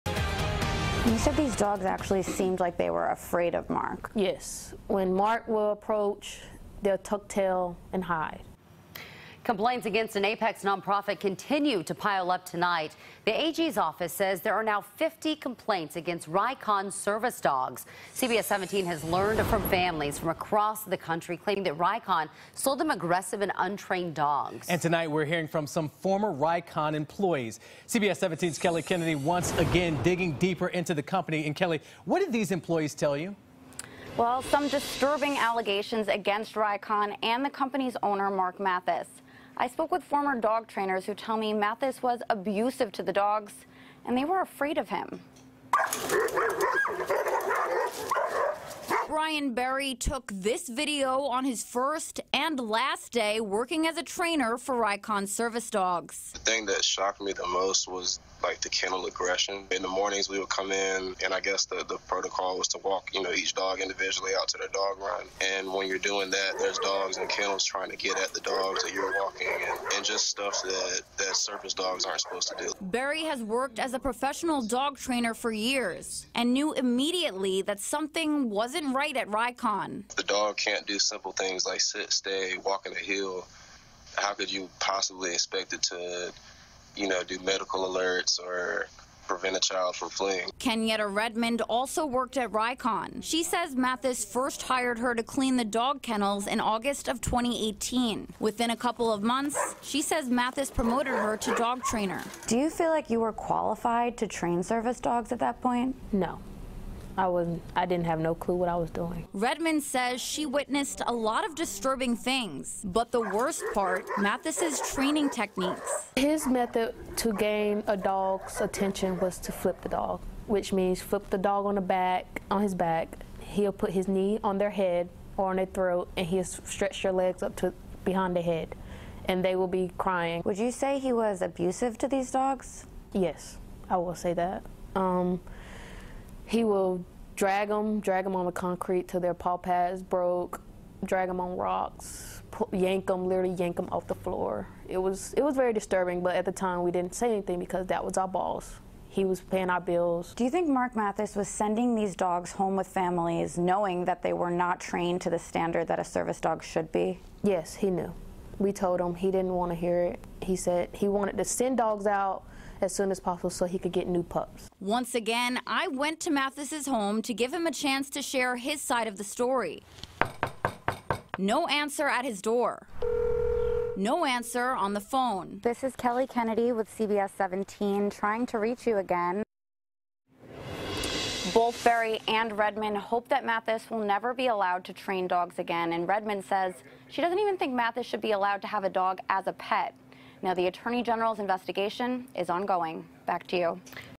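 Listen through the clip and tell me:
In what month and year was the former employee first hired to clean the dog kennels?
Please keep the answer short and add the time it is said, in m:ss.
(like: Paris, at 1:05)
August 2018, at 1:36.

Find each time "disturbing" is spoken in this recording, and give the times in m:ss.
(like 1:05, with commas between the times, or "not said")
0:34, 1:51, 2:25.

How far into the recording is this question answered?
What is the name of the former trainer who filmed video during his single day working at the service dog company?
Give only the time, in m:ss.
0:49.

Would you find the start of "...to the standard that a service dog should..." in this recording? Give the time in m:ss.
2:35.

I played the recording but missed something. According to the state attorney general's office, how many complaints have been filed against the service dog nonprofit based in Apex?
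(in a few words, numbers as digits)
50.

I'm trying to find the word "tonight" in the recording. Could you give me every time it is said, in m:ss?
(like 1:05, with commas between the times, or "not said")
0:12, 0:24.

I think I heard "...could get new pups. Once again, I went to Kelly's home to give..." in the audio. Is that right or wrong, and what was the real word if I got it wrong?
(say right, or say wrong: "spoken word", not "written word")
wrong: "Mathis", not "Kelly".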